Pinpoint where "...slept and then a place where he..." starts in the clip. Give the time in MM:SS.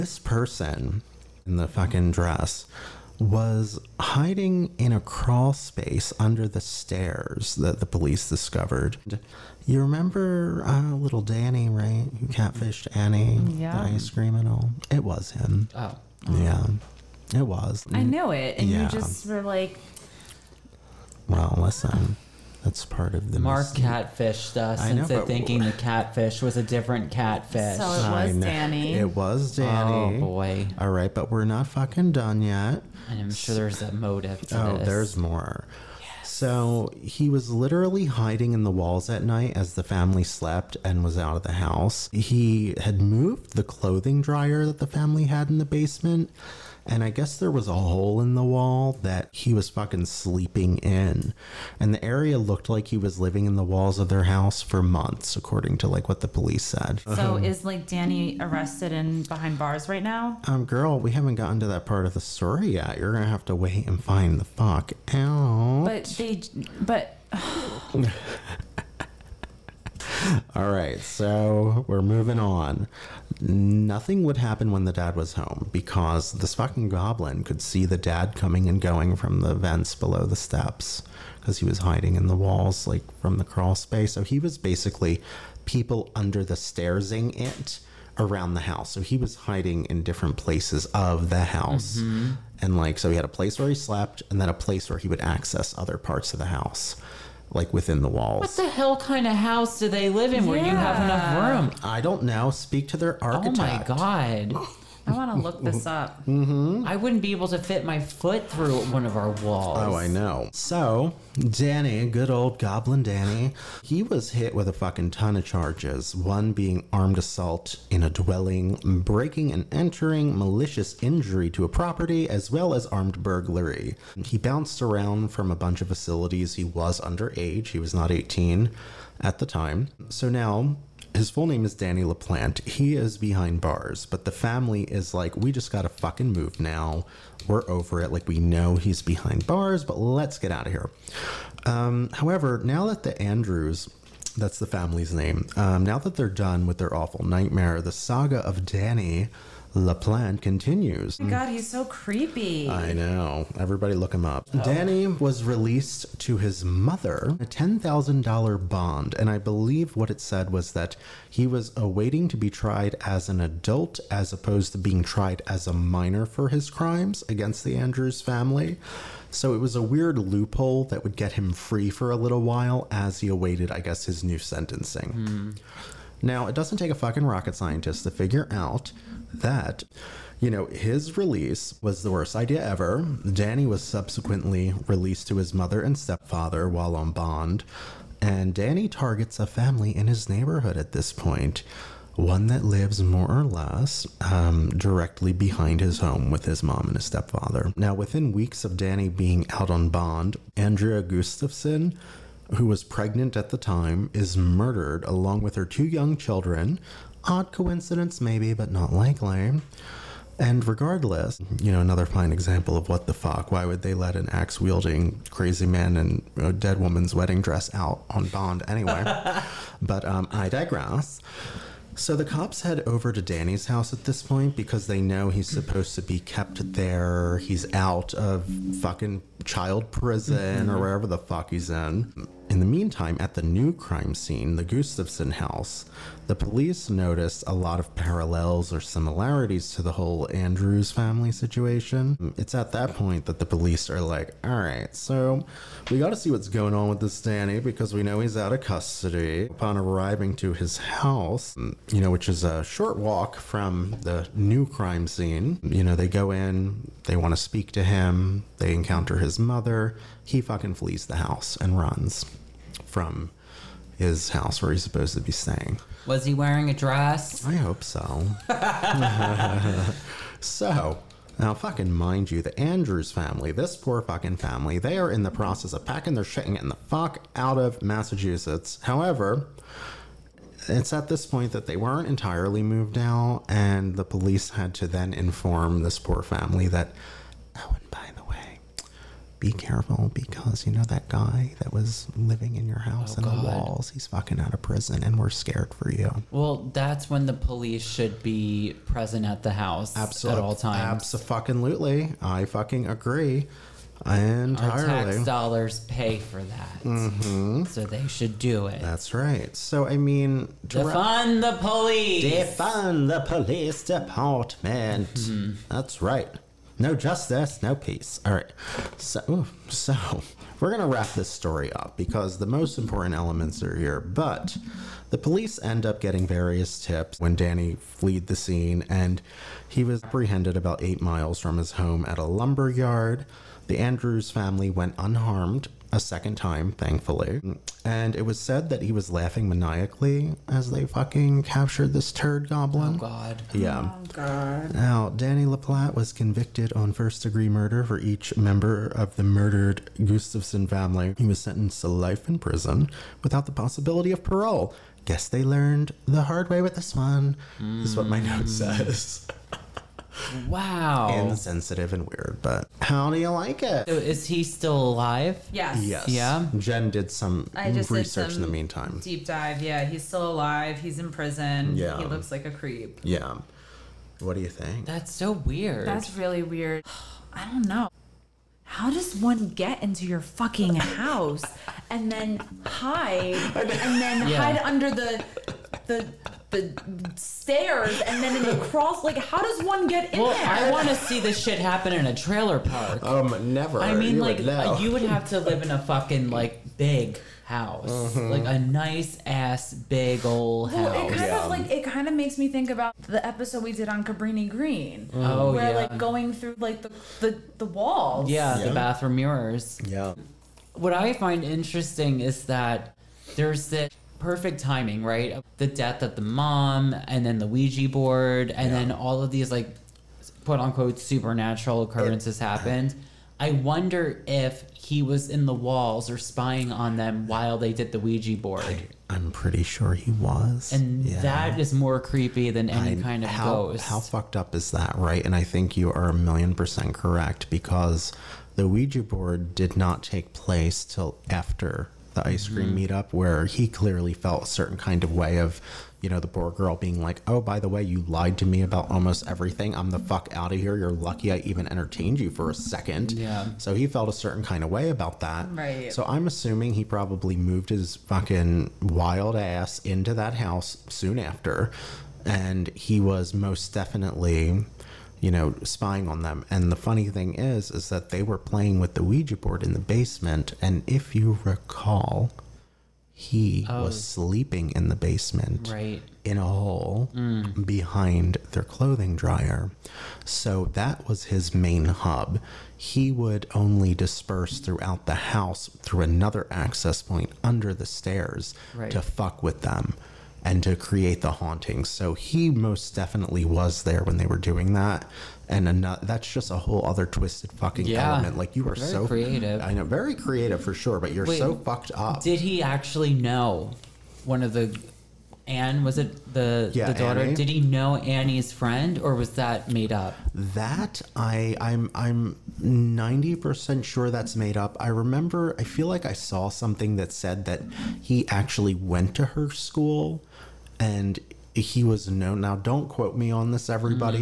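01:33.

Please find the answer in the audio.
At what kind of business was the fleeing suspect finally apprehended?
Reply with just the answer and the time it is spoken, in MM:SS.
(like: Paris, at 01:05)
A lumber yard, at 05:32.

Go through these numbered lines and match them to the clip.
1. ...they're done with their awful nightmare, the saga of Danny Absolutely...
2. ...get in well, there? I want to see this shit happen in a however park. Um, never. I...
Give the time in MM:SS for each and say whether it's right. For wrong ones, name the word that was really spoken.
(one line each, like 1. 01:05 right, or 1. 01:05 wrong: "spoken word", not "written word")
1. 02:26 wrong: "LaPlante", not "Absolutely"
2. 06:29 wrong: "trailer", not "however".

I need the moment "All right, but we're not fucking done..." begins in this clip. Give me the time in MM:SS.
00:30.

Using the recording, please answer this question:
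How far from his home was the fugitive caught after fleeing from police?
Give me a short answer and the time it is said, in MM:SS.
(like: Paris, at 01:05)
8 miles, at 05:30.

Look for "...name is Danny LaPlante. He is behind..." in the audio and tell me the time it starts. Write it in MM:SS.
02:11.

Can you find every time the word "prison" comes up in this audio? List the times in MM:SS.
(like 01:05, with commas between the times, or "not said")
03:49, 04:54, 05:52, 06:11.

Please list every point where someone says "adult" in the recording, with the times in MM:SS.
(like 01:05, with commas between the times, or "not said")
02:43.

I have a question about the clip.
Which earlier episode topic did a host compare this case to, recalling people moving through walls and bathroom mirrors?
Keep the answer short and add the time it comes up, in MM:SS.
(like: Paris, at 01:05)
Cabrini Green, at 06:44.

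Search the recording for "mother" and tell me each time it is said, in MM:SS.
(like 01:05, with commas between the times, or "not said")
02:36, 03:05, 04:19.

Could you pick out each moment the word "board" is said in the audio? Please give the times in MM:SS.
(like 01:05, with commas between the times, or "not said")
06:57, 07:08, 07:19, 07:49.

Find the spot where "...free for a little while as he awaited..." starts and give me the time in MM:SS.
02:51.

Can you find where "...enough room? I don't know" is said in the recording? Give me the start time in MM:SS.
01:41.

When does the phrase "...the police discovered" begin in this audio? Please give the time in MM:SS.
00:07.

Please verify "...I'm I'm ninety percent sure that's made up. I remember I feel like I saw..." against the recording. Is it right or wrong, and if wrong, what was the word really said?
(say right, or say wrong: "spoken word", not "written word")
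right.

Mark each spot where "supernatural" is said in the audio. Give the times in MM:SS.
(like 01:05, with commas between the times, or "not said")
07:00.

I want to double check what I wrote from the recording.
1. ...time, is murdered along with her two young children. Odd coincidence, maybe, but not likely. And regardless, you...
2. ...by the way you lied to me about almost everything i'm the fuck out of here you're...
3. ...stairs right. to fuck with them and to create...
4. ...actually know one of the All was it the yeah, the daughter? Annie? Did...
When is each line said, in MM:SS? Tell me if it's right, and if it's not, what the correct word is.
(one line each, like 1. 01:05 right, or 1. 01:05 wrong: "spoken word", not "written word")
1. 03:23 right
2. 07:27 right
3. 08:07 right
4. 08:22 wrong: "Anne", not "All".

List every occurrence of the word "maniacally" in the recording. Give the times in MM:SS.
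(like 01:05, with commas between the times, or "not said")
05:39.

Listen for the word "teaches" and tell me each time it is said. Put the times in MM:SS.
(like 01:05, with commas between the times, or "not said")
not said.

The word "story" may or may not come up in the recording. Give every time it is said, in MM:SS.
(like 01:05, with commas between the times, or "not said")
01:02, 05:21.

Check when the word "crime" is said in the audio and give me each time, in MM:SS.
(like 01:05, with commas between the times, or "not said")
02:46, 03:53, 04:14.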